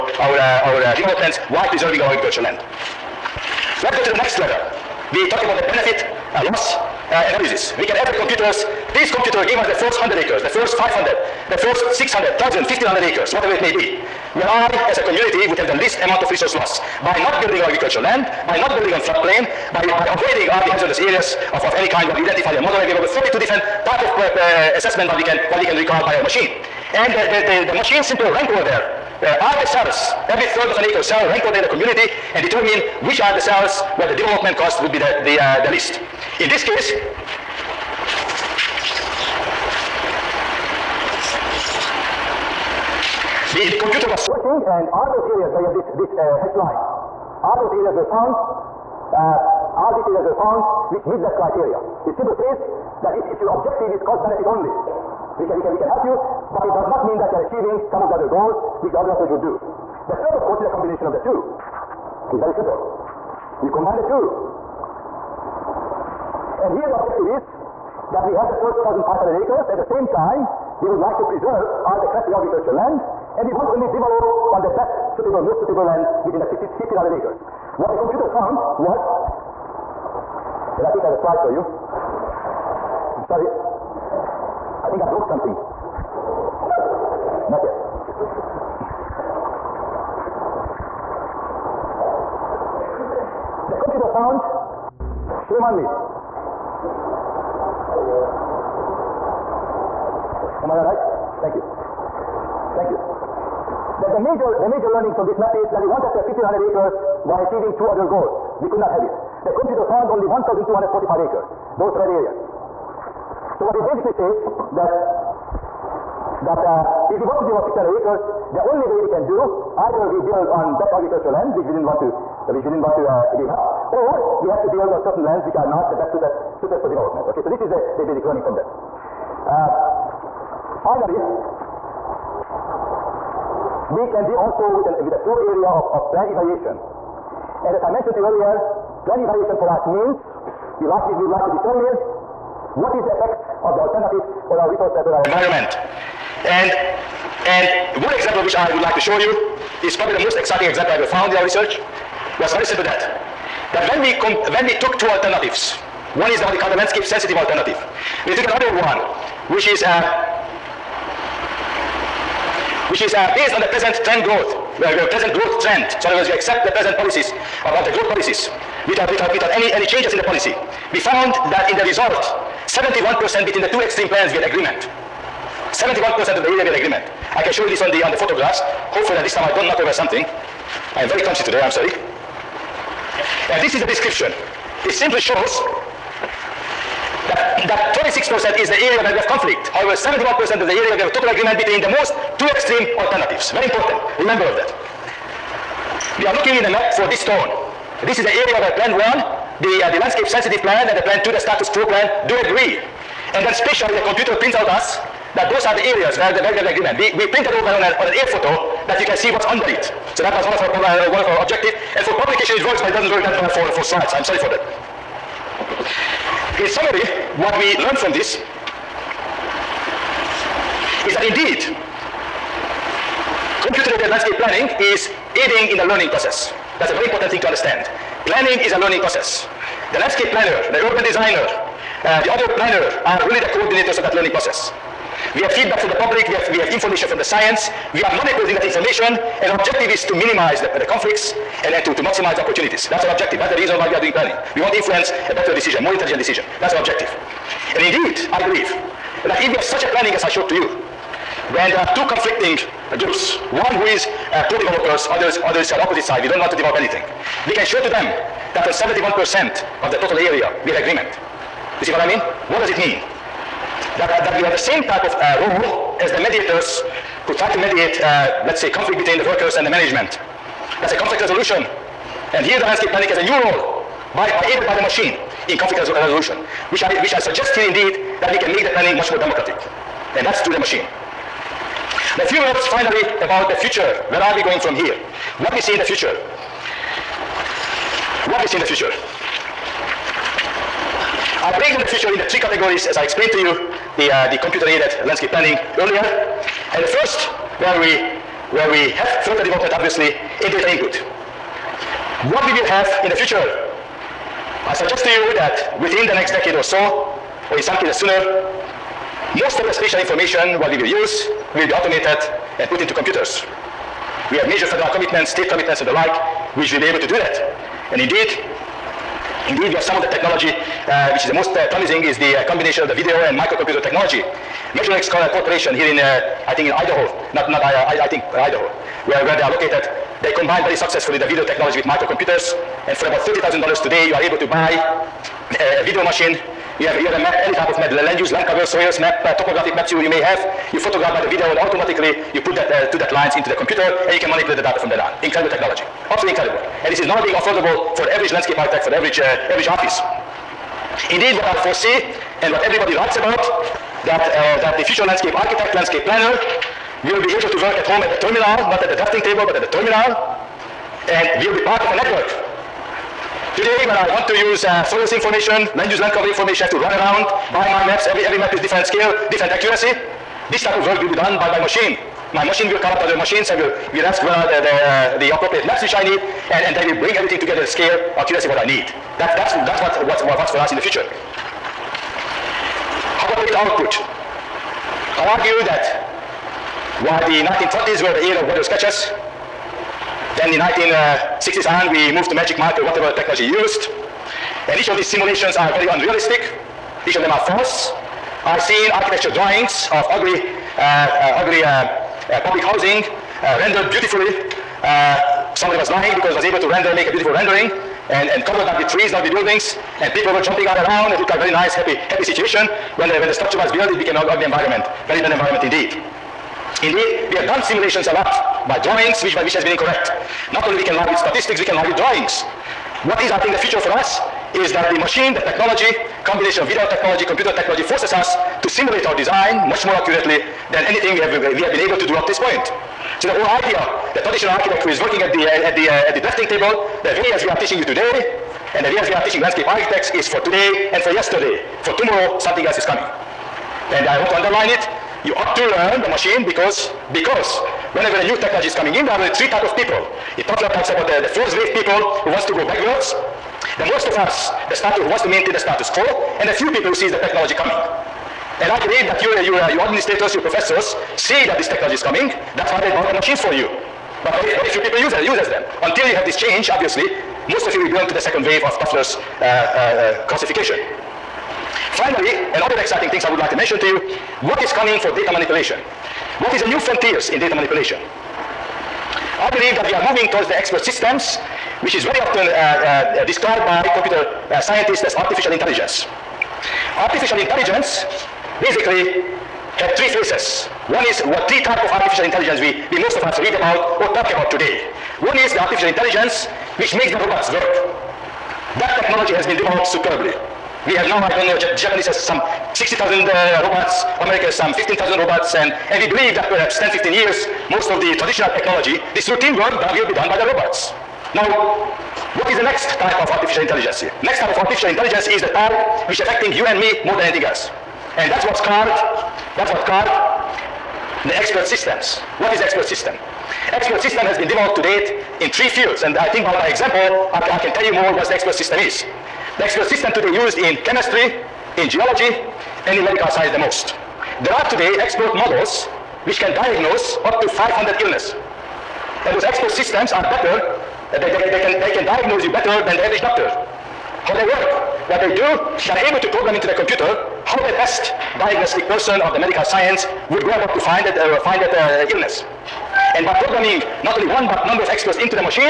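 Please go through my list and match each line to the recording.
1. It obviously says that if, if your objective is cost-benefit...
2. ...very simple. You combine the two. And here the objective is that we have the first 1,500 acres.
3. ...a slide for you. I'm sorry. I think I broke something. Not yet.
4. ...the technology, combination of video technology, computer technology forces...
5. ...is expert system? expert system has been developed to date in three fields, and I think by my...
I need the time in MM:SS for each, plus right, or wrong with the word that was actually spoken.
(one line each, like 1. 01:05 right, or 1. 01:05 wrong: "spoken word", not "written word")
1. 00:52 wrong: "simply", not "obviously"
2. 01:02 right
3. 01:21 right
4. 07:05 right
5. 08:42 right.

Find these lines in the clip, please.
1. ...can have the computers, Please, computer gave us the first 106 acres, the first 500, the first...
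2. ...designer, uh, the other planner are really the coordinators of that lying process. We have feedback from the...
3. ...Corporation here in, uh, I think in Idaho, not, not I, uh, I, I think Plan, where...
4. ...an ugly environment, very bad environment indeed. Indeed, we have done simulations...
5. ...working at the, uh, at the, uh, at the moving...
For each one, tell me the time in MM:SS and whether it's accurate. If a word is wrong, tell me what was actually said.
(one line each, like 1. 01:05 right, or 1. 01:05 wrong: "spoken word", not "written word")
1. 00:07 wrong: "100", not "106"
2. 03:51 wrong: "learning", not "lying"
3. 05:25 wrong: "Idaho", not "Plan"
4. 06:54 right
5. 07:14 wrong: "drafting", not "moving".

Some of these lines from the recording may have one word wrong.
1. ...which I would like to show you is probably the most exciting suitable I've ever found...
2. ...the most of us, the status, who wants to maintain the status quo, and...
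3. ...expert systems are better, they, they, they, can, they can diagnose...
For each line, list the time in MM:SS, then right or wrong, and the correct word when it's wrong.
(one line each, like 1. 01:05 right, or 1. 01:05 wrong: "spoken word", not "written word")
1. 02:28 wrong: "example", not "suitable"
2. 07:33 right
3. 08:59 right.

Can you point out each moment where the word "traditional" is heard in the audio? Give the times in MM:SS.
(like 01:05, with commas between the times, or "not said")
07:14, 08:28.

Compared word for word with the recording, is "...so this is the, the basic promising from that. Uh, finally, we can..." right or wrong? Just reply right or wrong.
wrong.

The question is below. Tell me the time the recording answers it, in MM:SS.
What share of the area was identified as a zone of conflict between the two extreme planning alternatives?
03:07.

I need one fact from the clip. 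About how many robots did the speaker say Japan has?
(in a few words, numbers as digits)
60,000.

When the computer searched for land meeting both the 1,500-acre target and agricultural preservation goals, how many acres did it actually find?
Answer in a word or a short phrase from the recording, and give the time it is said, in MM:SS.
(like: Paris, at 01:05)
1,245 acres, at 01:50.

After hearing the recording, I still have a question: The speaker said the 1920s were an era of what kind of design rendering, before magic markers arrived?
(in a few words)
water sketches.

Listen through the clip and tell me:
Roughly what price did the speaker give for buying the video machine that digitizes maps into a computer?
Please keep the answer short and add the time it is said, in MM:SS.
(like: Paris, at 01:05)
$30,000, at 05:33.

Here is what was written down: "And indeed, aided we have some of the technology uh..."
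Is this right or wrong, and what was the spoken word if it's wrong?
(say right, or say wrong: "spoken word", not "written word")
wrong: "indeed", not "aided".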